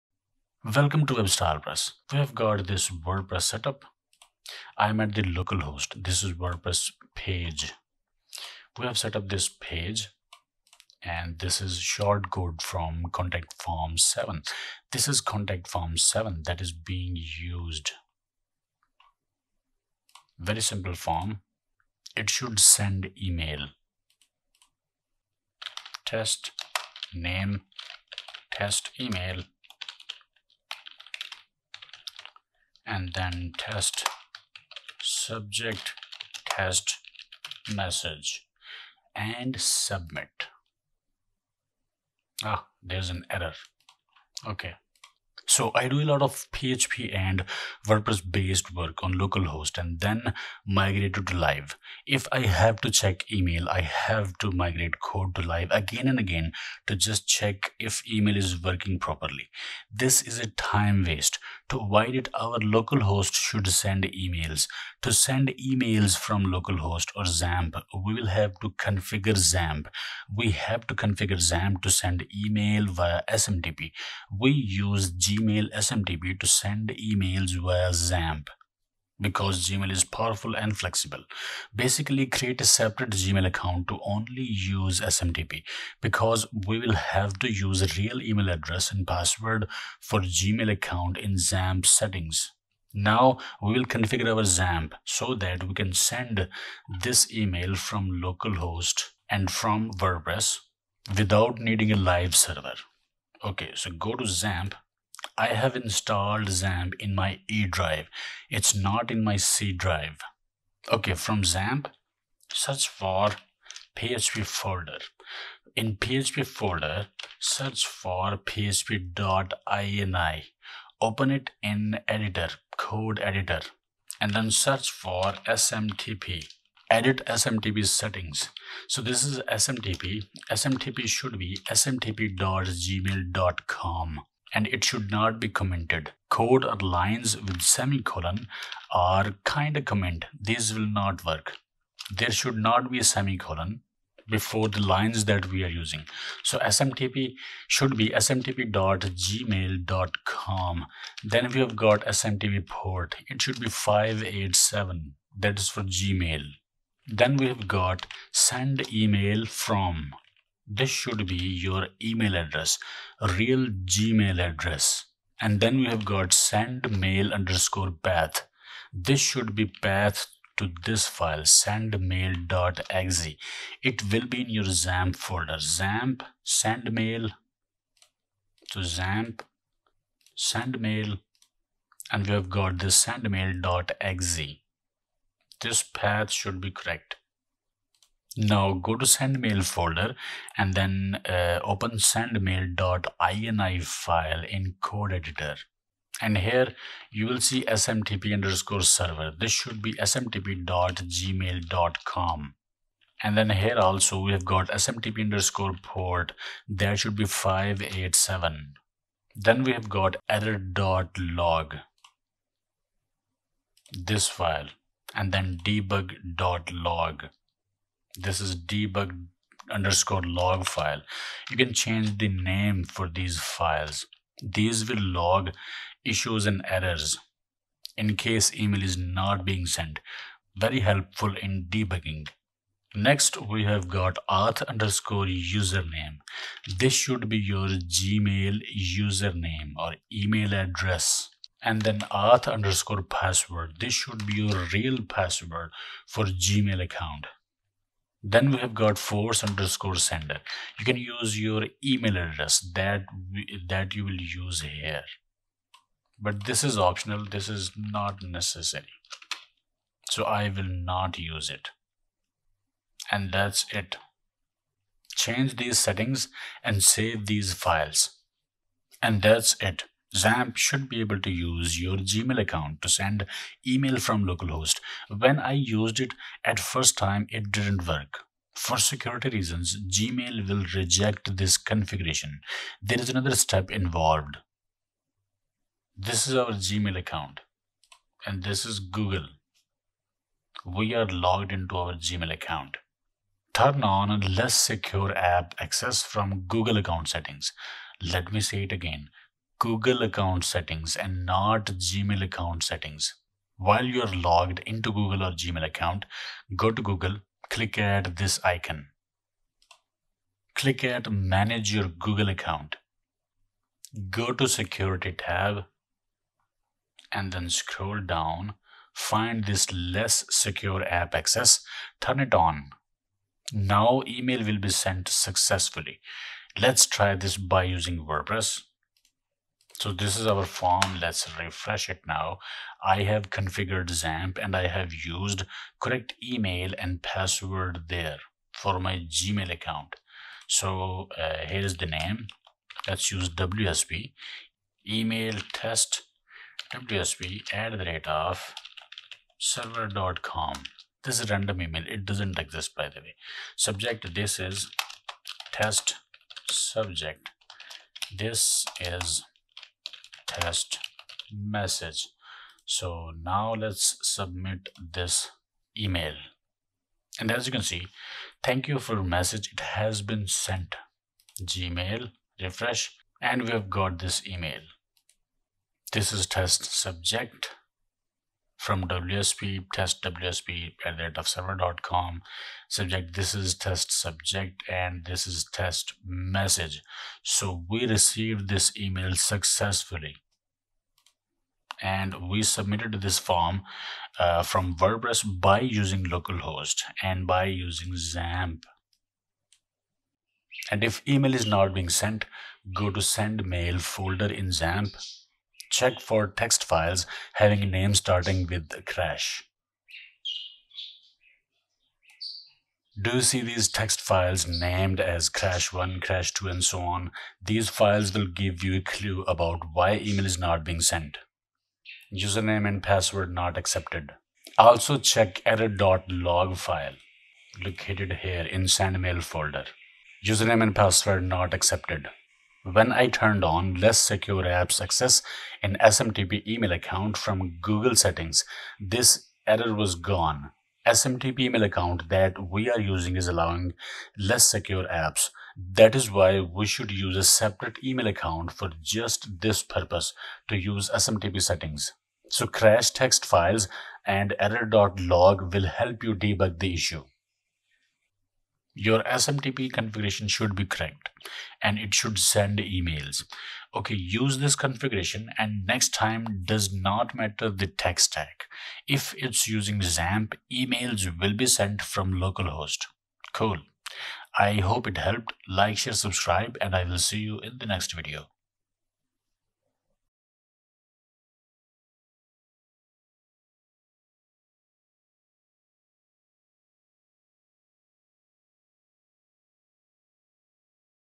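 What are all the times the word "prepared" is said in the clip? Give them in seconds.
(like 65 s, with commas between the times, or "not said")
not said.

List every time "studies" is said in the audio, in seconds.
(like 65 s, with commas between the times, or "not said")
not said.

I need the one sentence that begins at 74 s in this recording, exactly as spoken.
We use Gmail SMTP to send emails via XAMPP because Gmail is powerful and flexible.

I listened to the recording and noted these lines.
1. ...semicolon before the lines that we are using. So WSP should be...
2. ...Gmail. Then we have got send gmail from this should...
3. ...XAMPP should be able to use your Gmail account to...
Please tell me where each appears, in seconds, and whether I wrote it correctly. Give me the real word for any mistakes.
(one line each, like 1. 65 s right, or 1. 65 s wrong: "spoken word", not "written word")
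1. 143 s wrong: "SMTP", not "WSP"
2. 155 s wrong: "email", not "gmail"
3. 270 s right.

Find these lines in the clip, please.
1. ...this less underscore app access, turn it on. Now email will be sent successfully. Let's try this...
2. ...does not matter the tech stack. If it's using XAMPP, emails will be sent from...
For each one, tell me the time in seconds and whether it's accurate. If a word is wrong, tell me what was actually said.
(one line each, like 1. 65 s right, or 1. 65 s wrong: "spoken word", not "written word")
1. 319 s wrong: "secure", not "underscore"
2. 466 s right.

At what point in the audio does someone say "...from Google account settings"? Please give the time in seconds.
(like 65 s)
296 s.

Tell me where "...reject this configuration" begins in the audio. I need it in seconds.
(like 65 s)
280 s.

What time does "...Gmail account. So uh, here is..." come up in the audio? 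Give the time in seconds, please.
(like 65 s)
339 s.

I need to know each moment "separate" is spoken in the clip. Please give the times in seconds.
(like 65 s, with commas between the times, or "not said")
82 s, 447 s.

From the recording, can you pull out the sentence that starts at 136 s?
Code or lines with semicolon are kind of comment.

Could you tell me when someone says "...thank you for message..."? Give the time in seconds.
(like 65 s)
368 s.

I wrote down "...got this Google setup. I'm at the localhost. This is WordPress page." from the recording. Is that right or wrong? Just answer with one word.
wrong.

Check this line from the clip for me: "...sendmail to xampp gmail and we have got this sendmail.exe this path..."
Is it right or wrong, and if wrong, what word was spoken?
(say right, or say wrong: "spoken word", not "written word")
wrong: "sendmail", not "gmail".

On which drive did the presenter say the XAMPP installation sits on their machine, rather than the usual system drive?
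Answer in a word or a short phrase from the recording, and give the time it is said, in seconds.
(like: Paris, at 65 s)
E drive, at 107 s.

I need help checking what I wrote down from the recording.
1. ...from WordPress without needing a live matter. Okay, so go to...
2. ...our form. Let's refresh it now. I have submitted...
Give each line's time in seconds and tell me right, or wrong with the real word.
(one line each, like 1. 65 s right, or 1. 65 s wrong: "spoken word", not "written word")
1. 99 s wrong: "server", not "matter"
2. 330 s wrong: "configured", not "submitted".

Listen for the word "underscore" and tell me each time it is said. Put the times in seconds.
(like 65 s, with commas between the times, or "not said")
167 s, 198 s, 205 s, 219 s, 234 s, 242 s, 249 s.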